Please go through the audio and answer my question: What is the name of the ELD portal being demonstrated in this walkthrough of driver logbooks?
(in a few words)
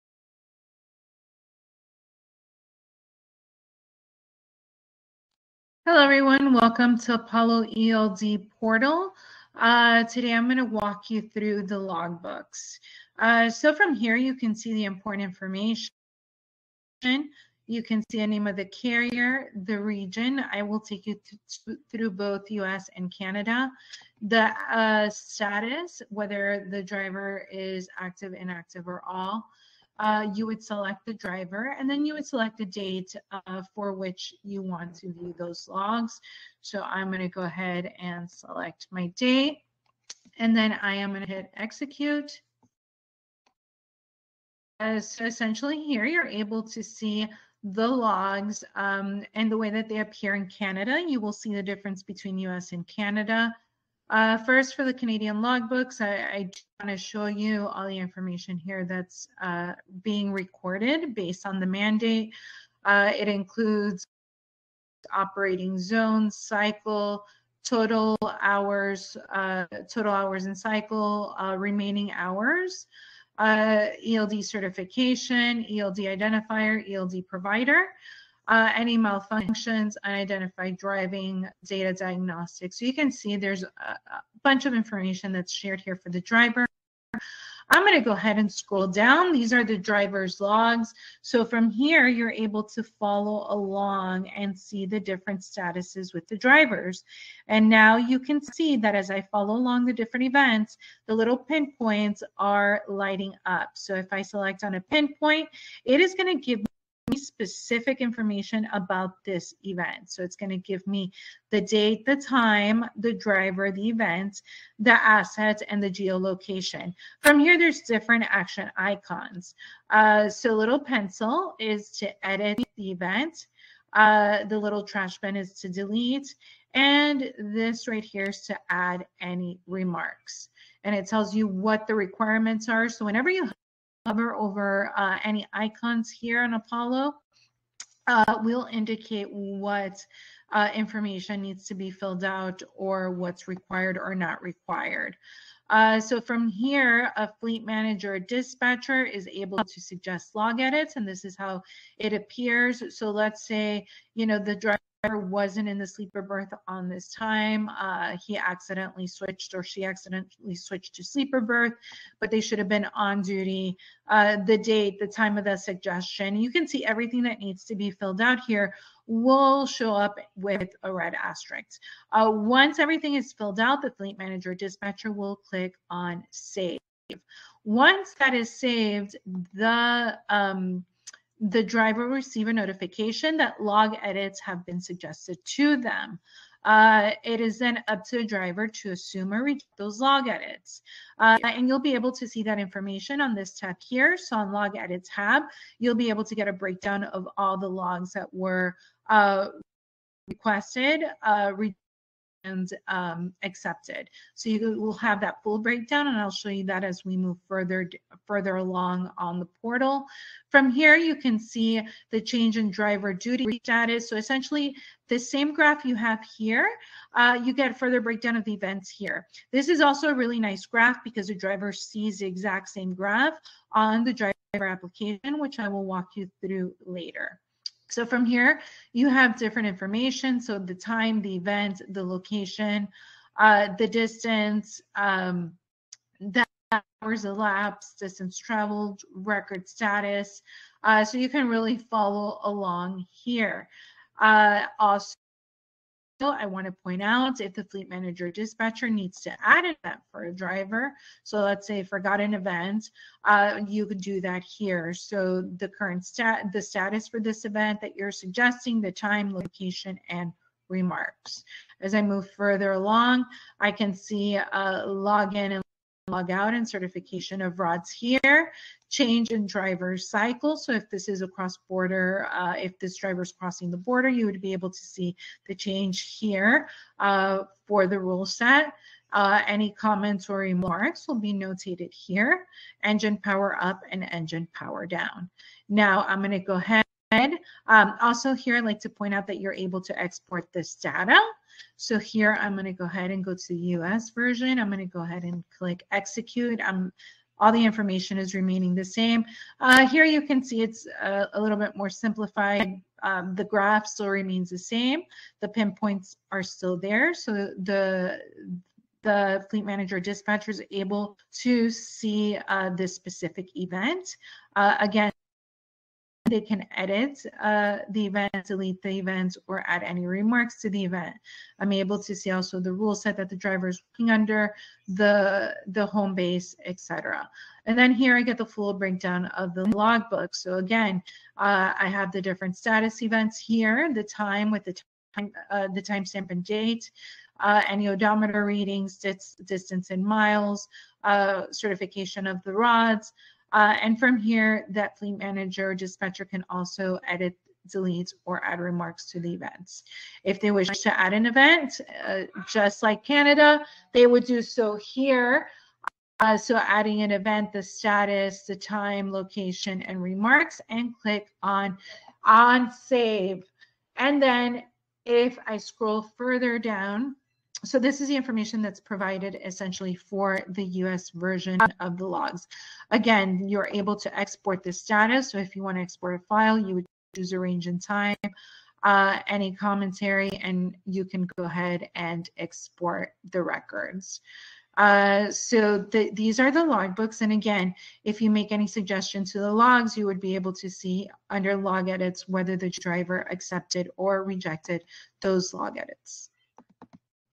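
Apollo ELD Portal.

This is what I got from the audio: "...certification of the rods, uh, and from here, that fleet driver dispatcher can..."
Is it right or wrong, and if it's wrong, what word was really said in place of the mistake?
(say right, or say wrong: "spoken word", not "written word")
wrong: "manager", not "driver".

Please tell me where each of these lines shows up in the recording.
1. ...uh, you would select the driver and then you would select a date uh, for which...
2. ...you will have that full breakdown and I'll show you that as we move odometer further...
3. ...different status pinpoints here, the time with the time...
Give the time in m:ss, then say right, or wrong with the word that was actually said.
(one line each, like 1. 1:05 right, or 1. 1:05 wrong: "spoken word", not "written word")
1. 0:30 right
2. 3:24 wrong: "further", not "odometer"
3. 5:32 wrong: "events", not "pinpoints".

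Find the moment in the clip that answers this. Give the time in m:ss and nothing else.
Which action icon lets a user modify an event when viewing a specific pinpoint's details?
2:00.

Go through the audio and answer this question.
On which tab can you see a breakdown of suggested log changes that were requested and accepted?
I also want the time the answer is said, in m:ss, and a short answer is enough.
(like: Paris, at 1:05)
log edit tab, at 3:14.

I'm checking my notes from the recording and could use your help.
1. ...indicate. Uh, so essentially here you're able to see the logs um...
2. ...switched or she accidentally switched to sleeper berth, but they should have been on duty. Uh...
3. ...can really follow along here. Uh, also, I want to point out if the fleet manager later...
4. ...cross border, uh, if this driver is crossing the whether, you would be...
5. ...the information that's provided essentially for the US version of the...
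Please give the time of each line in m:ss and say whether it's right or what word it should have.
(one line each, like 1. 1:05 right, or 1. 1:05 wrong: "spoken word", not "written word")
1. 0:41 wrong: "execute", not "indicate"
2. 2:39 right
3. 4:01 wrong: "dispatcher", not "later"
4. 4:31 wrong: "border", not "whether"
5. 6:08 right.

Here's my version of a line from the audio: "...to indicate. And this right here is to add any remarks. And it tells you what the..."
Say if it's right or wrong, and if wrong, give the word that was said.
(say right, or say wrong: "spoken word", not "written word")
wrong: "delete", not "indicate".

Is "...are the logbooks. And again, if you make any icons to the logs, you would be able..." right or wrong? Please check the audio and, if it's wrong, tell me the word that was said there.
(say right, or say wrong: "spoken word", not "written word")
wrong: "suggestions", not "icons".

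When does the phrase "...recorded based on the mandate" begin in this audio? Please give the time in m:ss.
1:00.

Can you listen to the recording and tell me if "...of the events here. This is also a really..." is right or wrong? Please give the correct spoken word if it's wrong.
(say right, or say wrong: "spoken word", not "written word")
right.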